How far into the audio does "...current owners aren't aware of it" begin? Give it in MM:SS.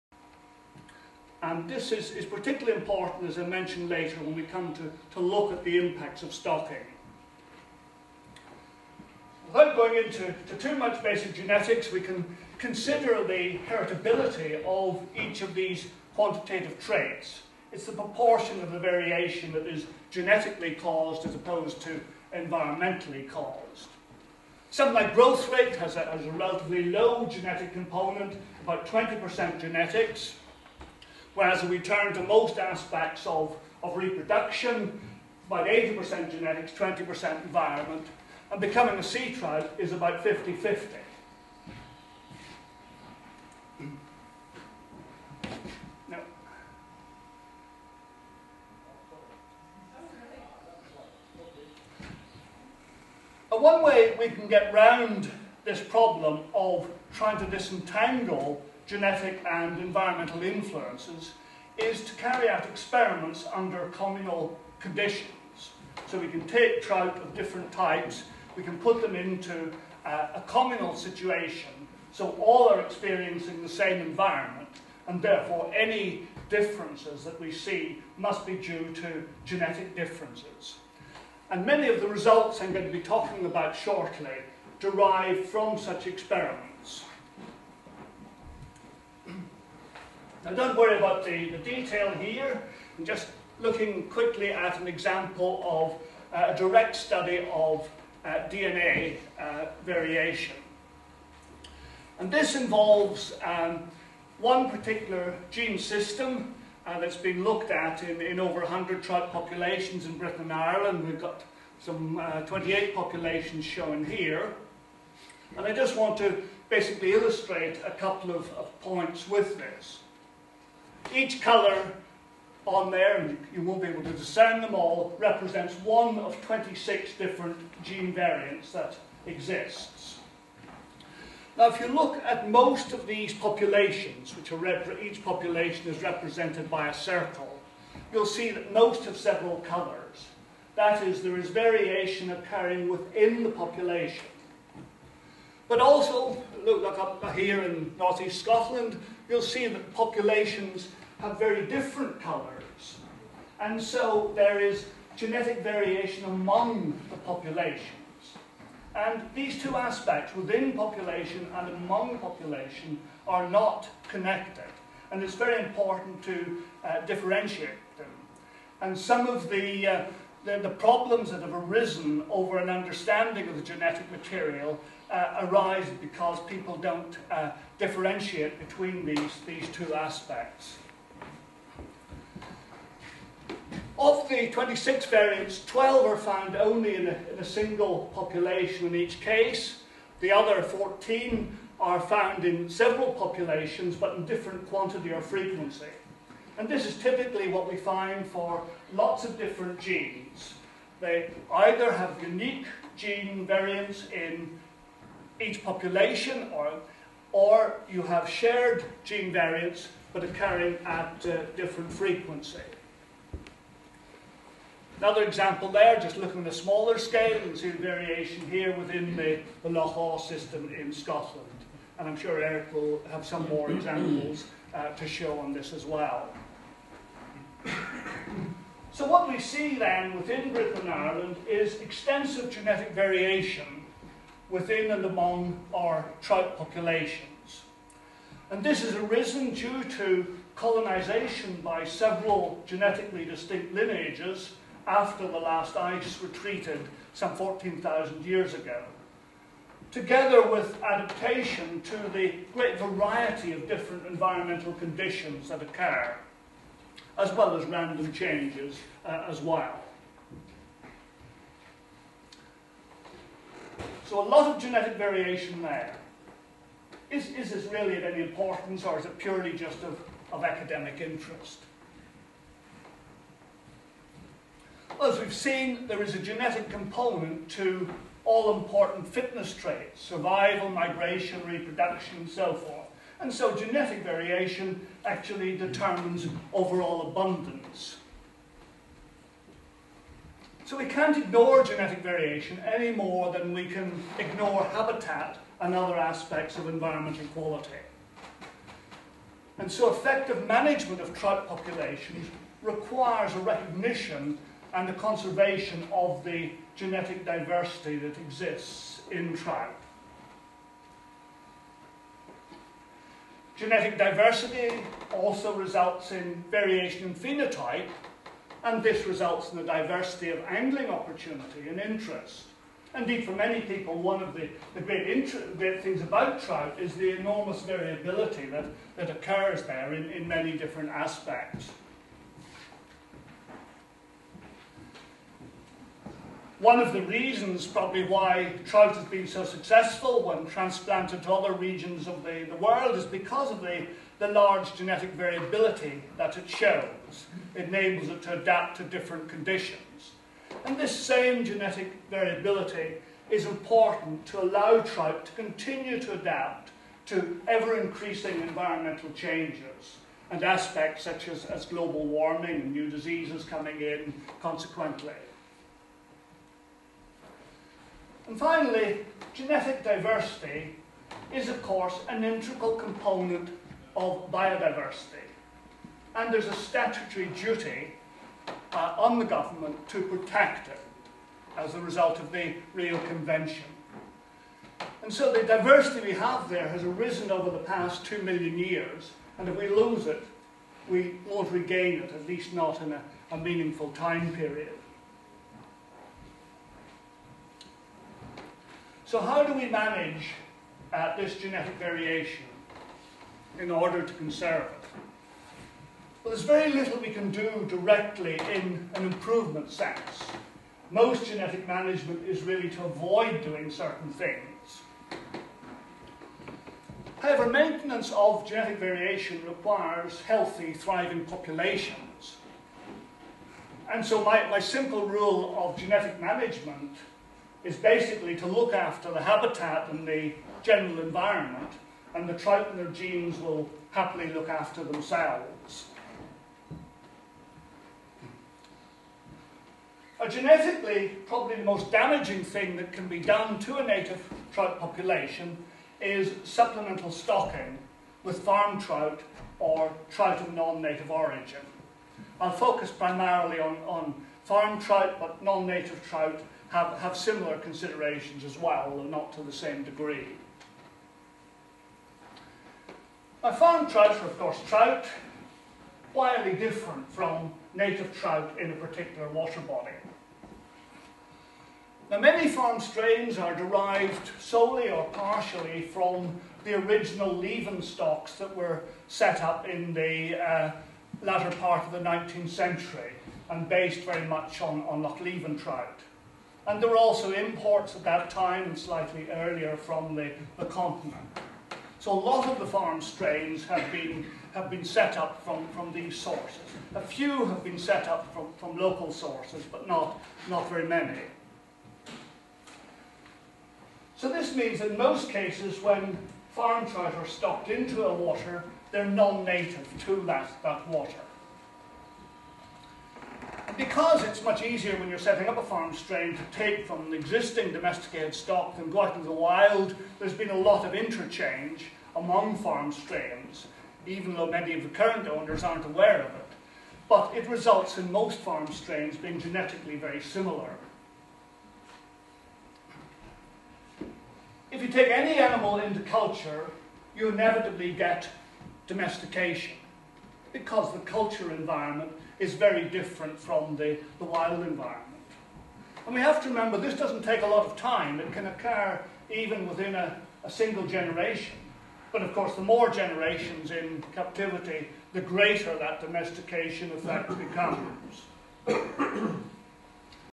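08:44.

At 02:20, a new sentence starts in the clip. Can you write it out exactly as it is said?
That is, there is variation occurring within the population.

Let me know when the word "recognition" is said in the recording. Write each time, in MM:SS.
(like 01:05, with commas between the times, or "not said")
05:03.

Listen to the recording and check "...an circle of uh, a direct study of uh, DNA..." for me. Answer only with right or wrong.
wrong.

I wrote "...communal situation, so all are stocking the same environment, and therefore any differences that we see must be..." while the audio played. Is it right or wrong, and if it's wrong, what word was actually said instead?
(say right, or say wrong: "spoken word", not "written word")
wrong: "experiencing", not "stocking".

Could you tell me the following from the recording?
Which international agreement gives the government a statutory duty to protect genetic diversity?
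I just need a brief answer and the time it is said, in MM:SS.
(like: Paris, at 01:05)
Rio Convention, at 06:22.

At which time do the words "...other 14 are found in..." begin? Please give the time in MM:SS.
03:10.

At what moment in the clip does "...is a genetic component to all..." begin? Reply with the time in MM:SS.
04:36.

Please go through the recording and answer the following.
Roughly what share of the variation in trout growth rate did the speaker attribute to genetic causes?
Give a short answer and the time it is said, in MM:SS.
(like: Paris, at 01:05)
20%, at 00:28.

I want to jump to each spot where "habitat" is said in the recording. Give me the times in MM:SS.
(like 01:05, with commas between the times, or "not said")
04:54, 07:09.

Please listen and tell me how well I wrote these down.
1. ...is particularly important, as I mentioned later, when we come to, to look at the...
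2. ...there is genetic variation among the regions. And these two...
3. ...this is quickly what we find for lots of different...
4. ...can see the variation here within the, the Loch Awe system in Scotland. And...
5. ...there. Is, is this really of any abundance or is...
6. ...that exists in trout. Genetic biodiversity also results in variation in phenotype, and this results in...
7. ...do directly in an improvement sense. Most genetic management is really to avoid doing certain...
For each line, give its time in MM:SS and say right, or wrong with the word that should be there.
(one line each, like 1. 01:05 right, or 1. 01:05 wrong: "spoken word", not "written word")
1. 00:02 right
2. 02:34 wrong: "populations", not "regions"
3. 03:16 wrong: "typically", not "quickly"
4. 03:37 right
5. 04:25 wrong: "importance", not "abundance"
6. 05:07 wrong: "diversity", not "biodiversity"
7. 06:47 right.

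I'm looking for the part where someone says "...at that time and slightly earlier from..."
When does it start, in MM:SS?
08:07.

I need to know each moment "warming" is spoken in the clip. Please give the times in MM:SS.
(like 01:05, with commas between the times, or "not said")
06:02.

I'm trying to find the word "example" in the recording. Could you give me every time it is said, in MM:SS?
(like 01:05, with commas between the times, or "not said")
01:34, 03:35, 03:43.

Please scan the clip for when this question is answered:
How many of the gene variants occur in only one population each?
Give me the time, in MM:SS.
03:05.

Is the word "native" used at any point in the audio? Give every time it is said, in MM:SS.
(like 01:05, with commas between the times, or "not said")
07:23, 07:30, 07:35, 07:47, 08:29.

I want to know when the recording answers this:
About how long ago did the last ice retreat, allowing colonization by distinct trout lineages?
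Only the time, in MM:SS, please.
04:07.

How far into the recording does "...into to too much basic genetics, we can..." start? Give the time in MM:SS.
00:10.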